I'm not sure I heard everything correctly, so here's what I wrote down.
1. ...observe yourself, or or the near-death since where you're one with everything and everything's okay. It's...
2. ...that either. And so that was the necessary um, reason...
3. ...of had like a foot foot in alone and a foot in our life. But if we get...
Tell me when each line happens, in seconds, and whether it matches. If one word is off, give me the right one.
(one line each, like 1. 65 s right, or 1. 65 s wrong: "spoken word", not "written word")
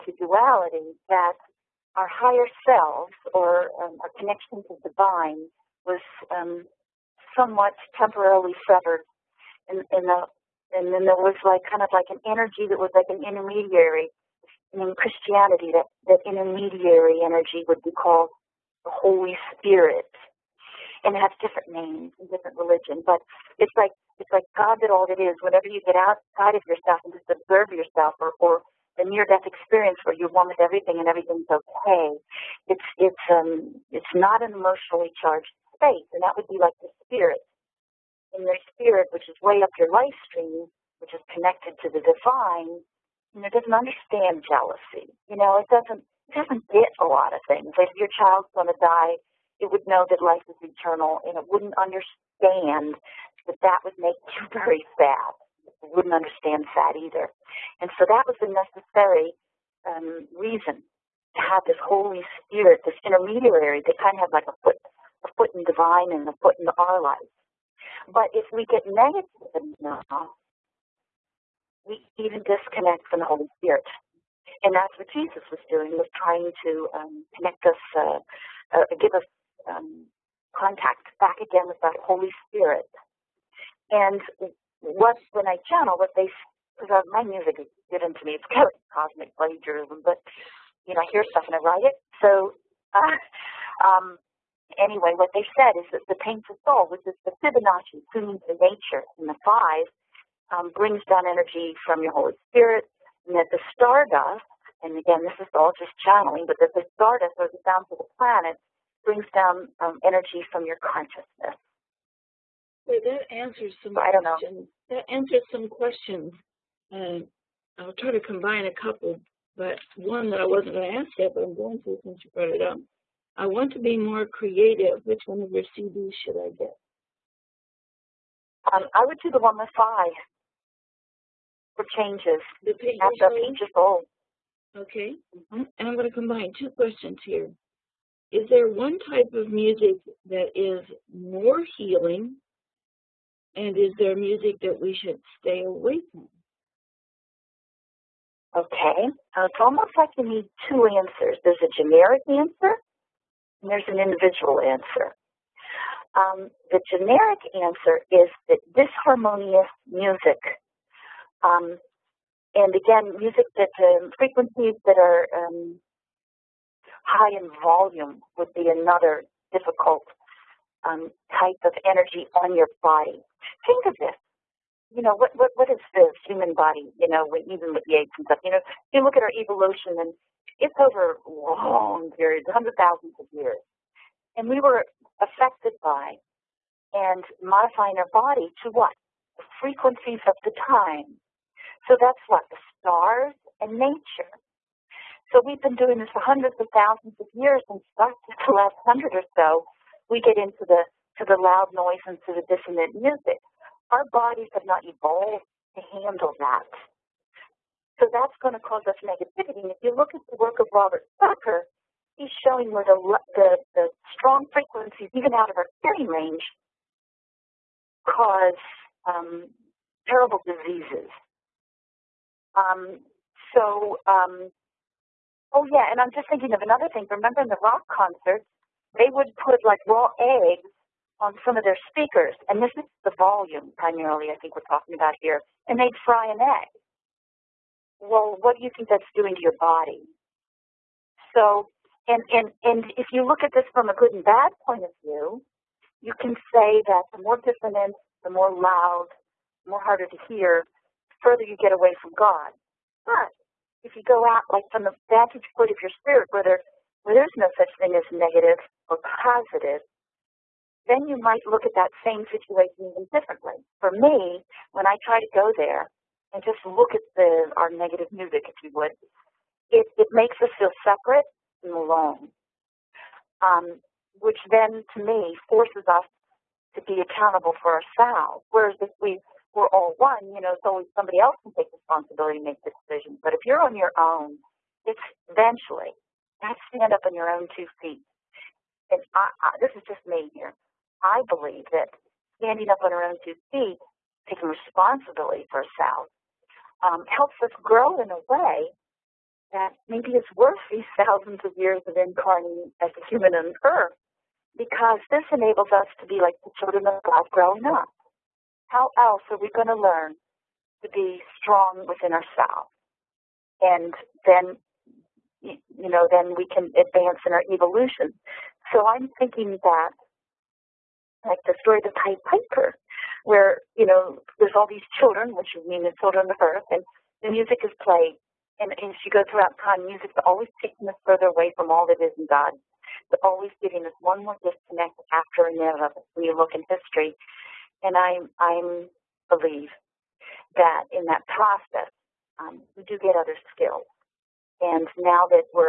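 1. 27 s wrong: "experience", not "since"
2. 56 s right
3. 64 s wrong: "divine", not "alone".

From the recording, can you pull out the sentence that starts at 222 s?
Um, so, um, oh yeah, and I'm just thinking of another thing.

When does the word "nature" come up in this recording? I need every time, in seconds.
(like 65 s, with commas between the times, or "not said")
98 s, 193 s.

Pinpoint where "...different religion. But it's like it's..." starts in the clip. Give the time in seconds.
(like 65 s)
22 s.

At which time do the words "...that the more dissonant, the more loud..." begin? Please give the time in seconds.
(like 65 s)
246 s.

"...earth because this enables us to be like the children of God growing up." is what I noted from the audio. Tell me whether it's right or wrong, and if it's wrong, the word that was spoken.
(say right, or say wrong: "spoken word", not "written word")
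right.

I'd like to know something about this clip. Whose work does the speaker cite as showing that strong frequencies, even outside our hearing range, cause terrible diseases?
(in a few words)
Robert Becker.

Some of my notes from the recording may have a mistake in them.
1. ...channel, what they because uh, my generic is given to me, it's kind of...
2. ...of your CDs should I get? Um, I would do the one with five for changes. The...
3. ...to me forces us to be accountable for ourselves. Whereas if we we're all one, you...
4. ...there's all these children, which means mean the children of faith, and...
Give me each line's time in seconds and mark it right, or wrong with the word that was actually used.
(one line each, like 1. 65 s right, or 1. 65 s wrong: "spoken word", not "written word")
1. 85 s wrong: "music", not "generic"
2. 125 s right
3. 274 s right
4. 324 s wrong: "earth", not "faith".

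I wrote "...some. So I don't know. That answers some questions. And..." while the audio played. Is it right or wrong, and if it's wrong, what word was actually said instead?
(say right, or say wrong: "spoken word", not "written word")
right.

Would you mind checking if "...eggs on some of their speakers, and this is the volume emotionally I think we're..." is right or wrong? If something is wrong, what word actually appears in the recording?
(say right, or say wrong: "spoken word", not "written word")
wrong: "primarily", not "emotionally".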